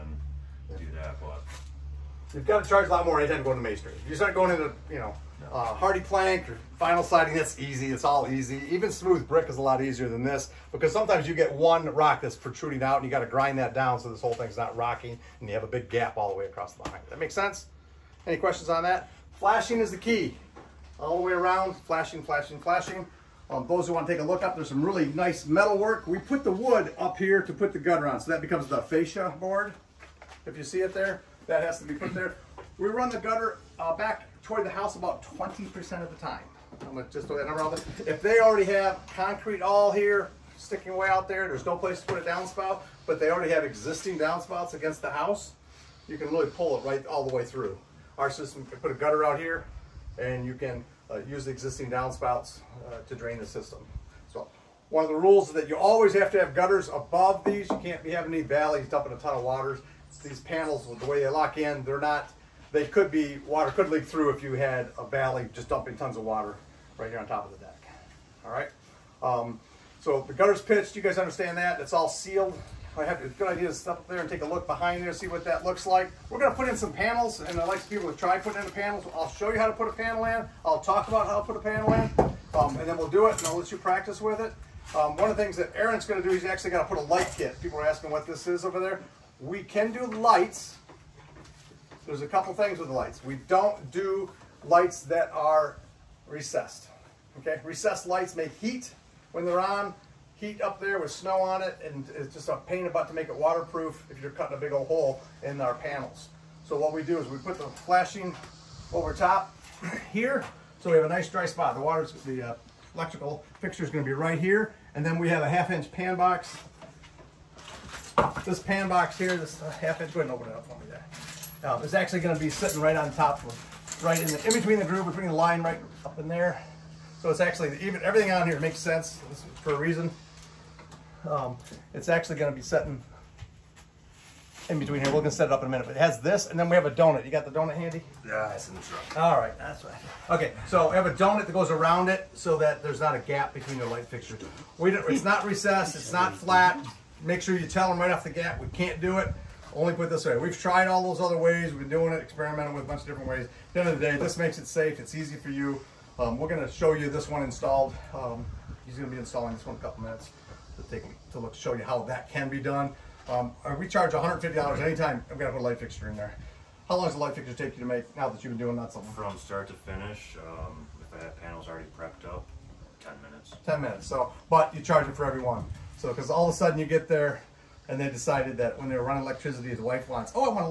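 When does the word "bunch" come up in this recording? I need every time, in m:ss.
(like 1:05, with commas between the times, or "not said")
2:32.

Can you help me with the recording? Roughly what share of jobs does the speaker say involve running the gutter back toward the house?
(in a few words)
20%.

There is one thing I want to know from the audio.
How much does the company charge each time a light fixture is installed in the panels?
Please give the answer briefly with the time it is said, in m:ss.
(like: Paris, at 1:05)
$150, at 2:44.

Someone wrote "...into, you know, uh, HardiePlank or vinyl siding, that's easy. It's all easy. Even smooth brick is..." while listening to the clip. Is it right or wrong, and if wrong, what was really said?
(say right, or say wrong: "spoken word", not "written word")
right.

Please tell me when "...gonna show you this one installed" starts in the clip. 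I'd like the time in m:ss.
2:36.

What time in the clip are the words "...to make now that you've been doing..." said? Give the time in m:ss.
2:47.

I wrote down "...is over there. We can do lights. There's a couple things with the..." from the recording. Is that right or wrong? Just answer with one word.
right.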